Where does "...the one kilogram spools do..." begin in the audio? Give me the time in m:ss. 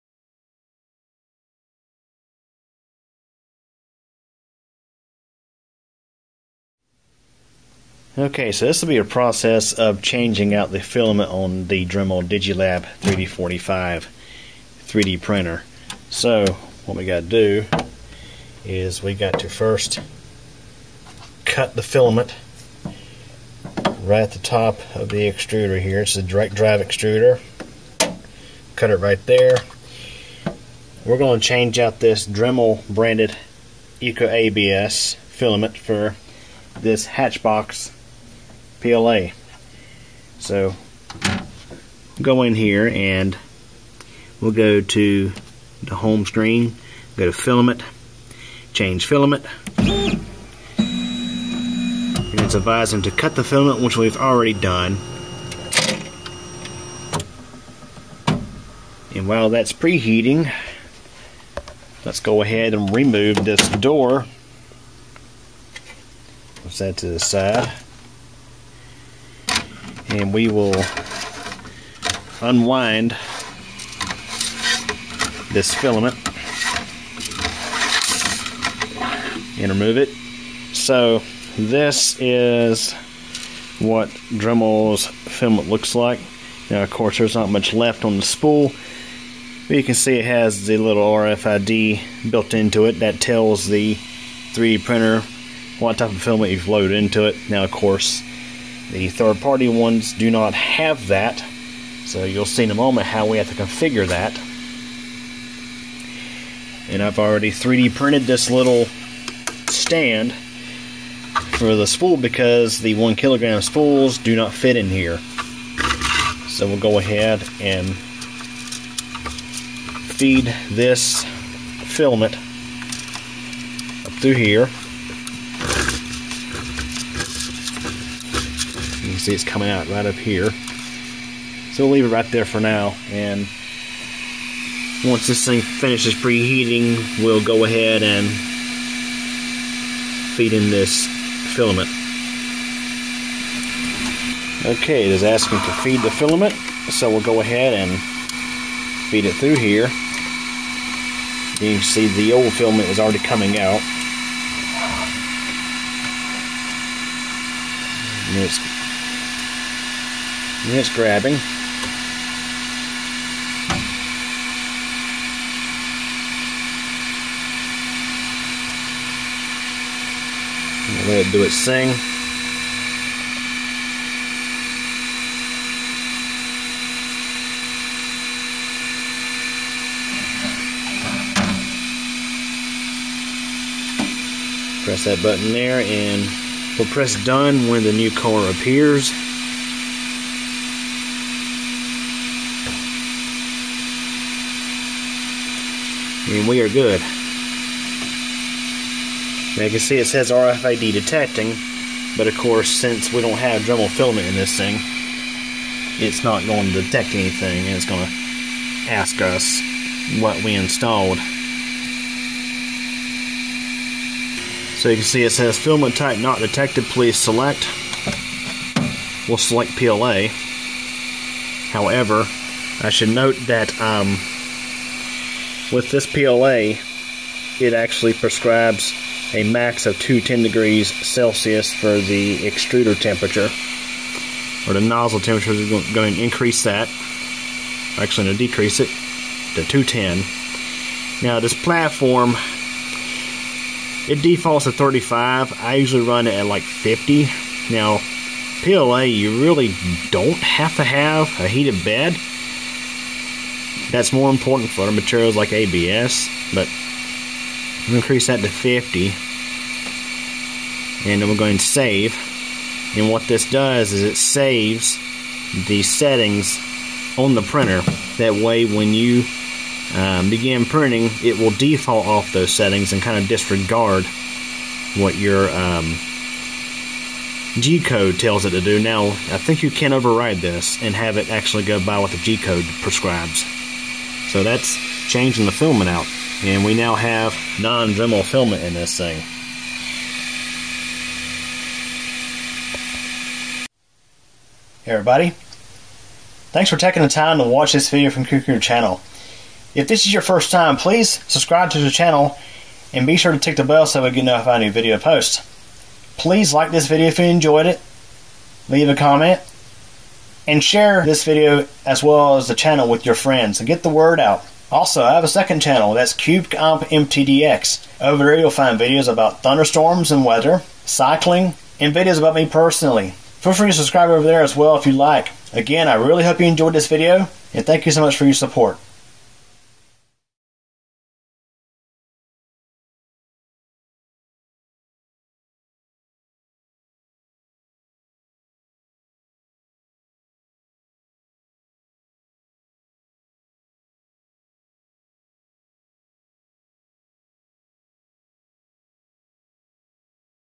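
1:52.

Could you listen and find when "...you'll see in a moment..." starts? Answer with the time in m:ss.
1:42.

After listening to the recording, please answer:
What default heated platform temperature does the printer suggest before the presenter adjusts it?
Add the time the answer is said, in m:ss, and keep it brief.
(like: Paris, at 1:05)
35, at 4:04.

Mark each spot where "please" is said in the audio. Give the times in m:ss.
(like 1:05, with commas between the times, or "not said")
3:36, 5:00, 5:06.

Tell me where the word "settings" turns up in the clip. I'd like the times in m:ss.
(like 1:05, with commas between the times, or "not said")
4:25, 4:32.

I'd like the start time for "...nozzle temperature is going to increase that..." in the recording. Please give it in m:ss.
3:54.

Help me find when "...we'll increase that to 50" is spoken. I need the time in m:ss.
4:17.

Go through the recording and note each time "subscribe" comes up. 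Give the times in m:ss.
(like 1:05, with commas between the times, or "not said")
5:01, 5:23.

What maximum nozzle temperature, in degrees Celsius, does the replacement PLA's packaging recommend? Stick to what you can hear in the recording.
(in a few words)
210.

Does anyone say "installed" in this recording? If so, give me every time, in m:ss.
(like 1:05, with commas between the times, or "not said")
3:30.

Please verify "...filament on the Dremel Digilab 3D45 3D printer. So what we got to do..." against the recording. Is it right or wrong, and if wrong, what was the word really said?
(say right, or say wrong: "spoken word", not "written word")
right.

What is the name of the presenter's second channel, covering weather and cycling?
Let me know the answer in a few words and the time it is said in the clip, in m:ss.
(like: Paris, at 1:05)
CubeComp MTDX, at 5:16.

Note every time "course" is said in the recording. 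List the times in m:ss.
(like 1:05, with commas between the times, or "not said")
1:26, 1:37, 3:22.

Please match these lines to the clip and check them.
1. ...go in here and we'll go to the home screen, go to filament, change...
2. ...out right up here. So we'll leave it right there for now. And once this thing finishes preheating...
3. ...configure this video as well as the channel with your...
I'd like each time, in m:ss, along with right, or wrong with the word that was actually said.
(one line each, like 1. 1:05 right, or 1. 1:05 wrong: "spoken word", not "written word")
1. 0:42 right
2. 2:09 right
3. 5:10 wrong: "share", not "configure".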